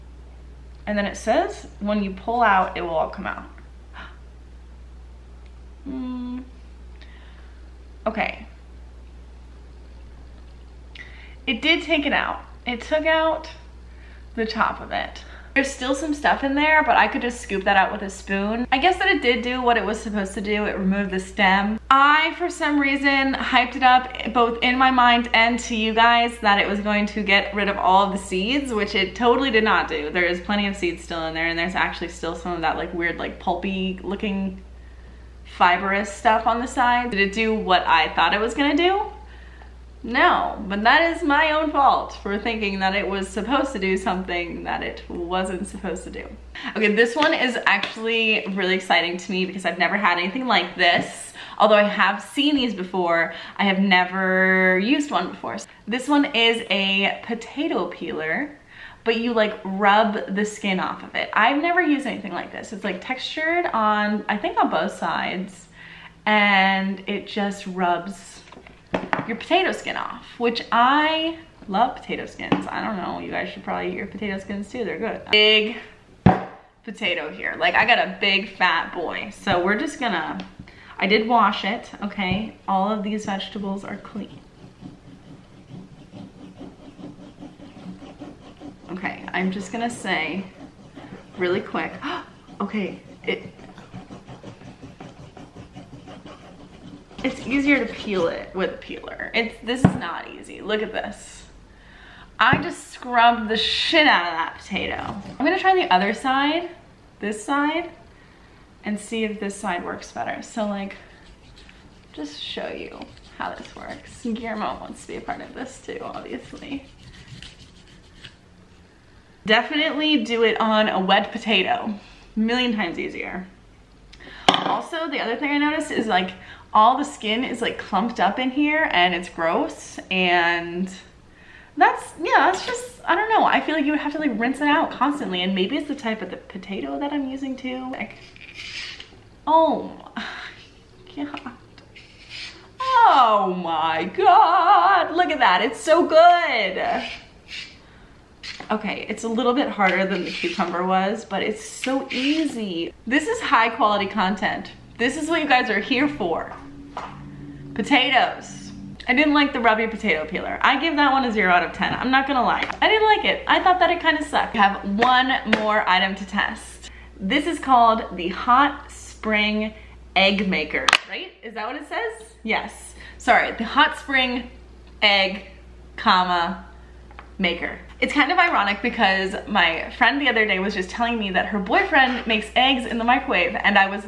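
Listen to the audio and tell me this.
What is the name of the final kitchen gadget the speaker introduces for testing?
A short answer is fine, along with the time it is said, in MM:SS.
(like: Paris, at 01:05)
Hot Spring Egg Maker, at 02:48.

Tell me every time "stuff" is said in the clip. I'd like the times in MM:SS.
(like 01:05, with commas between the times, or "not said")
00:16, 00:36.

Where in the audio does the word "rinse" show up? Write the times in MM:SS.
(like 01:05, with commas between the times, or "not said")
02:14.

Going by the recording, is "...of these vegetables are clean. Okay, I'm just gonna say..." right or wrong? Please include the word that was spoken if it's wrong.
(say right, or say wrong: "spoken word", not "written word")
right.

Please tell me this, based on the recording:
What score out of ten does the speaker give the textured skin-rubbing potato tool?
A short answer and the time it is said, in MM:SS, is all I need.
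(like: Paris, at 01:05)
0, at 02:41.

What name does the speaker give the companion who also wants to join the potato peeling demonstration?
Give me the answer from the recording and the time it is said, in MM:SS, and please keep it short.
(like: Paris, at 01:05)
Guillermo, at 01:54.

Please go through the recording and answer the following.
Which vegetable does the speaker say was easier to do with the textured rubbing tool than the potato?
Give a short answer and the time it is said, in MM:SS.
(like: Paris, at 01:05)
cucumber, at 02:30.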